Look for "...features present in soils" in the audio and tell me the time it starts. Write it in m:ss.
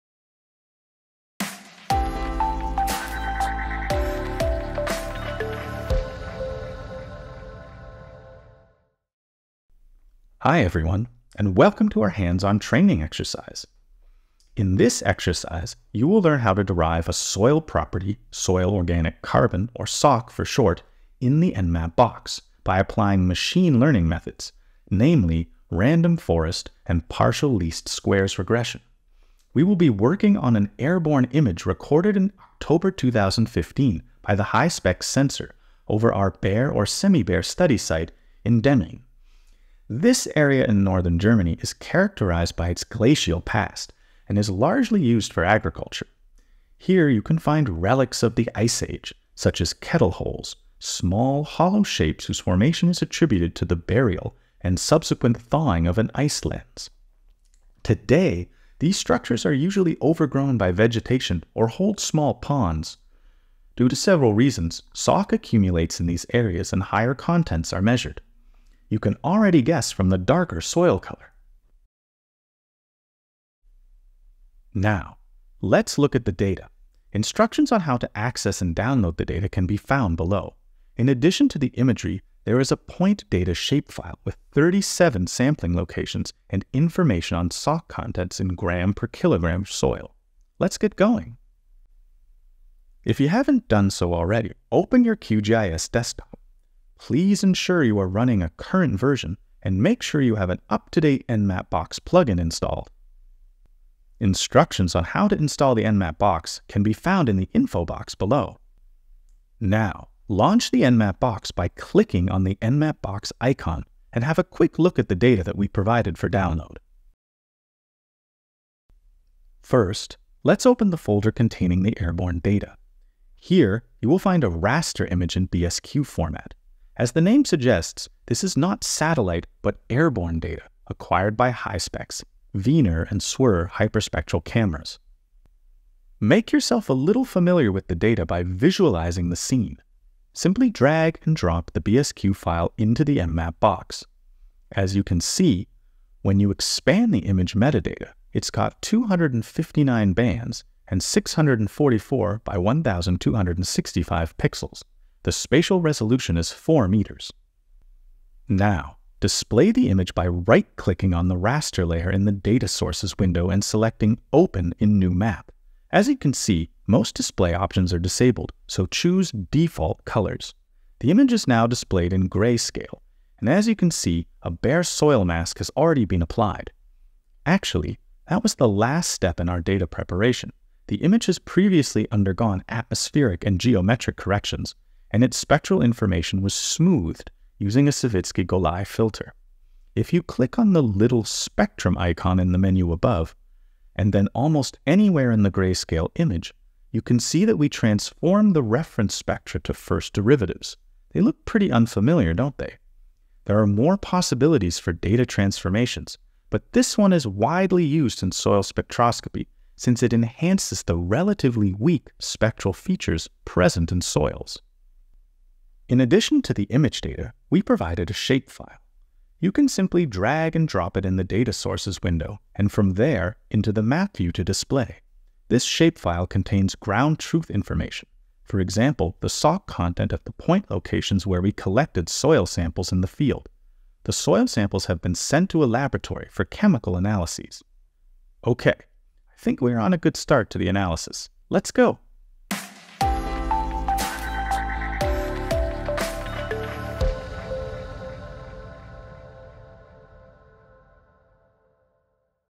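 3:32.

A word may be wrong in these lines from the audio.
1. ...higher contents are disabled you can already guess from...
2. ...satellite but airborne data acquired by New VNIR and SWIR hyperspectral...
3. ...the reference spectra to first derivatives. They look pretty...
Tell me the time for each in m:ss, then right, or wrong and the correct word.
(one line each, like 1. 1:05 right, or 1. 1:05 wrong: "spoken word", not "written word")
1. 1:06 wrong: "measured", not "disabled"
2. 2:08 wrong: "HySpex", not "New"
3. 3:18 right.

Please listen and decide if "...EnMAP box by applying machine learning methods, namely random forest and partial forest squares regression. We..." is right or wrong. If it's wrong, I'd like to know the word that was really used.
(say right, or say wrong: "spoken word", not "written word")
wrong: "least", not "forest".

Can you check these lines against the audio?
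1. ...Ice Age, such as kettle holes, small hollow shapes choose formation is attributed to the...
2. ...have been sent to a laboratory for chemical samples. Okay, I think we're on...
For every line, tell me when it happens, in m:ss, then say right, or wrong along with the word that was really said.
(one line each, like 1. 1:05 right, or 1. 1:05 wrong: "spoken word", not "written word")
1. 0:48 wrong: "whose", not "choose"
2. 3:54 wrong: "analyses", not "samples".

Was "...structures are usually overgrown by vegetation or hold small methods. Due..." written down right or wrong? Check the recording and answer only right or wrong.
wrong.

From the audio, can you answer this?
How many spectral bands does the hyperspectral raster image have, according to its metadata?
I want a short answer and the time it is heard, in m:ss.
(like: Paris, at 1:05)
259, at 2:28.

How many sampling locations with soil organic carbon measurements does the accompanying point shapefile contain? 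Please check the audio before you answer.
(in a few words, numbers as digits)
37.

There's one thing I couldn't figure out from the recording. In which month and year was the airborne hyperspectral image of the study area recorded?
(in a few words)
October 2015.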